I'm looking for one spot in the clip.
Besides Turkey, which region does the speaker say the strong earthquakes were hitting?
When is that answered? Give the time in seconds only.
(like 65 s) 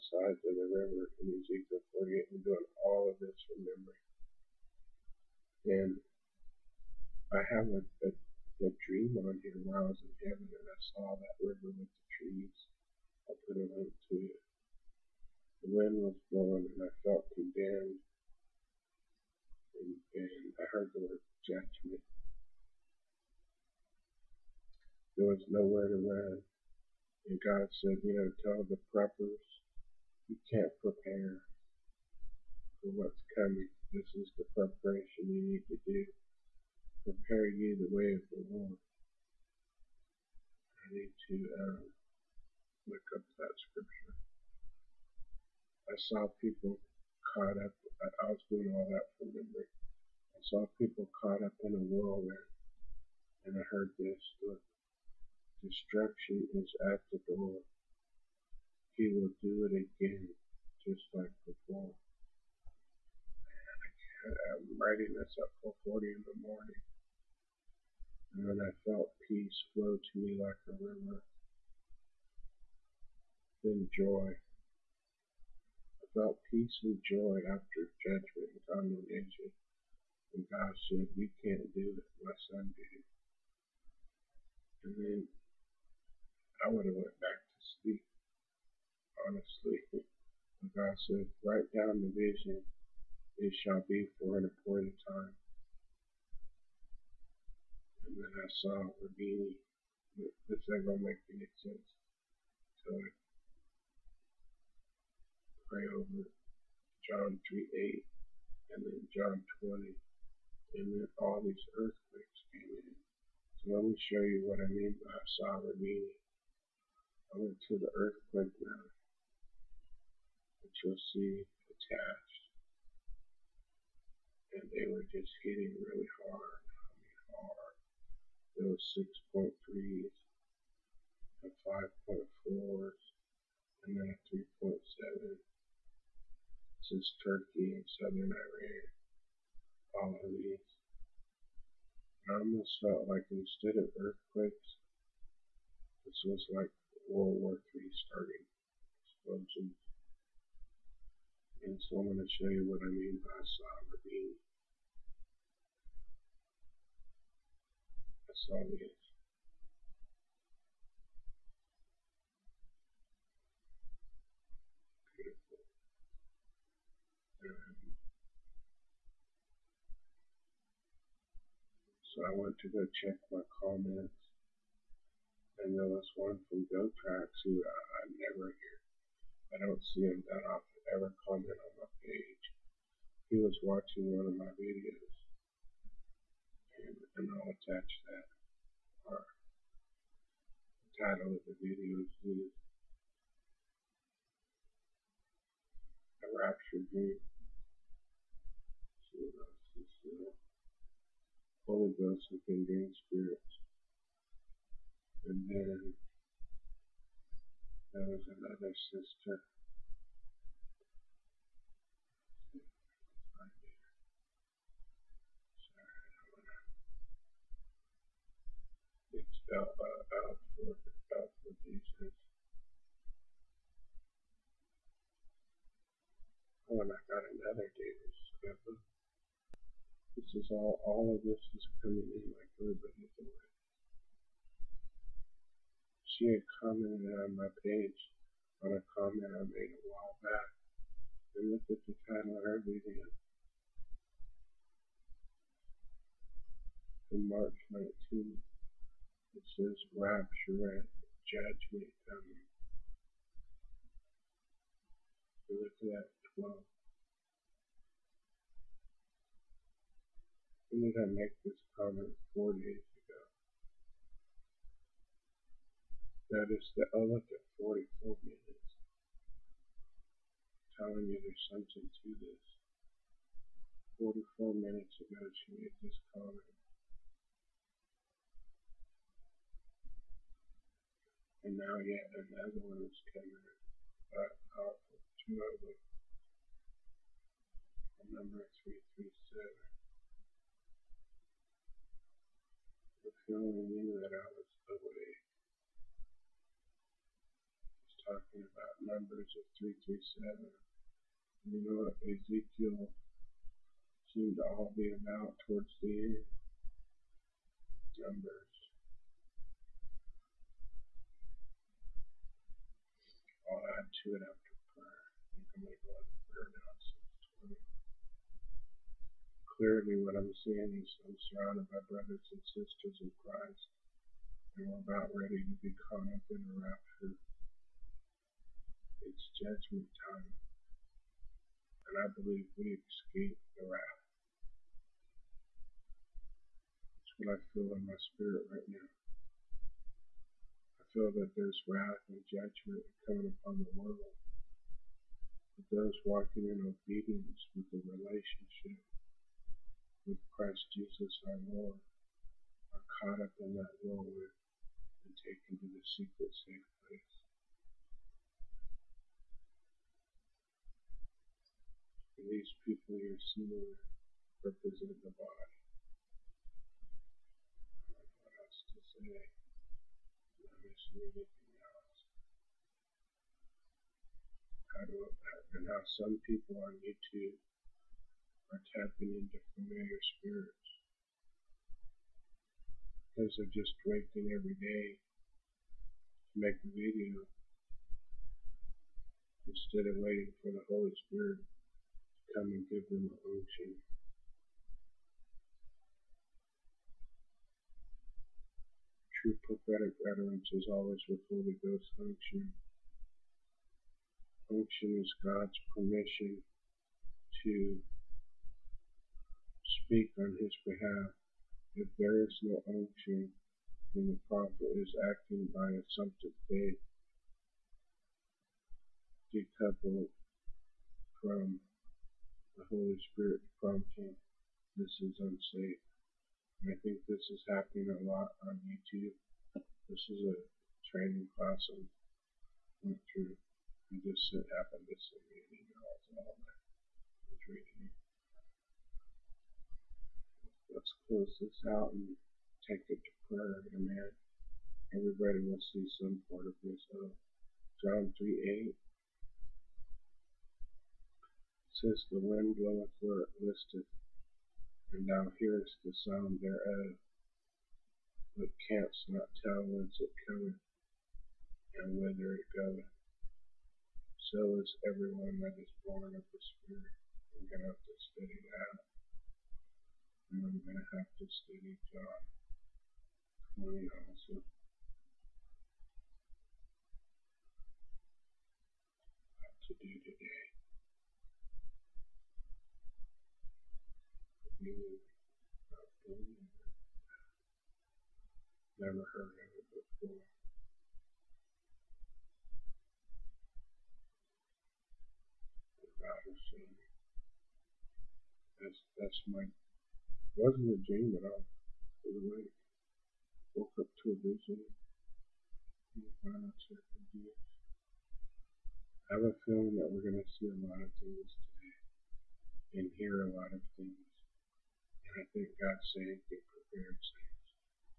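137 s.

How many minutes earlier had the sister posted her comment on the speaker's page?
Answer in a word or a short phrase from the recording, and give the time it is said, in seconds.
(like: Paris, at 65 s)
44, at 274 s.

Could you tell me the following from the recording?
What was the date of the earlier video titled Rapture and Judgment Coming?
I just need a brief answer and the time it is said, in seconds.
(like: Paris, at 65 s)
March 19th, at 247 s.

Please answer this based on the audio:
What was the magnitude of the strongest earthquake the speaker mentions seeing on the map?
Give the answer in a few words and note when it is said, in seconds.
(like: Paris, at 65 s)
6.3, at 128 s.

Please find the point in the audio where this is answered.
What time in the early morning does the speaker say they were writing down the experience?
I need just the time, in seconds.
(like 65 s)
65 s.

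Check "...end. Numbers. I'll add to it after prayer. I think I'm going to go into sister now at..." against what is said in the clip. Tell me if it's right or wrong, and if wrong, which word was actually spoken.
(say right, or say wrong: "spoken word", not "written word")
wrong: "prayer", not "sister".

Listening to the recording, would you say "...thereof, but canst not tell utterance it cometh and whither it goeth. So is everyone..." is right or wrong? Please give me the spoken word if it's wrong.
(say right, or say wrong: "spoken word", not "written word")
wrong: "whence", not "utterance".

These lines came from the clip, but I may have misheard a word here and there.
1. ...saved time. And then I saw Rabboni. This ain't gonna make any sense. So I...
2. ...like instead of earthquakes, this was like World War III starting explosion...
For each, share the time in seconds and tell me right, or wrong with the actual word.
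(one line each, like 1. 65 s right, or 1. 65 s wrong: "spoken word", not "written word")
1. 94 s wrong: "appointed", not "saved"
2. 143 s right.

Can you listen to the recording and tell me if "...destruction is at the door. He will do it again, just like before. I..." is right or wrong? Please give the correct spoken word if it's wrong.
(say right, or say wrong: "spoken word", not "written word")
right.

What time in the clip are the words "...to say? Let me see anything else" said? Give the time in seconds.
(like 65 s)
368 s.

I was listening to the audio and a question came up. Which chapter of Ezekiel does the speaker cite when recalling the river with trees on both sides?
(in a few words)
Ezekiel 48.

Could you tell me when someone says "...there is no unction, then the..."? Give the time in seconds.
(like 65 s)
411 s.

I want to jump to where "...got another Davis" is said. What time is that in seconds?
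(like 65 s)
227 s.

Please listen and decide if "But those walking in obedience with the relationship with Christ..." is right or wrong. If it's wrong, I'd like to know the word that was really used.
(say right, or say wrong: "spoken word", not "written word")
right.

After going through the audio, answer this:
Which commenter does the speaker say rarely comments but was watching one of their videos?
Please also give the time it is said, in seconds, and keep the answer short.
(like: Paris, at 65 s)
GoTrax, at 176 s.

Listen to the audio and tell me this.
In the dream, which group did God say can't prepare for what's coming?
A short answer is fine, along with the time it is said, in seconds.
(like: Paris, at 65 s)
the preppers, at 28 s.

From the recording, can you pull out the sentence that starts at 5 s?
And I have a, a, a dream on here where I was in heaven and I saw that river with the trees.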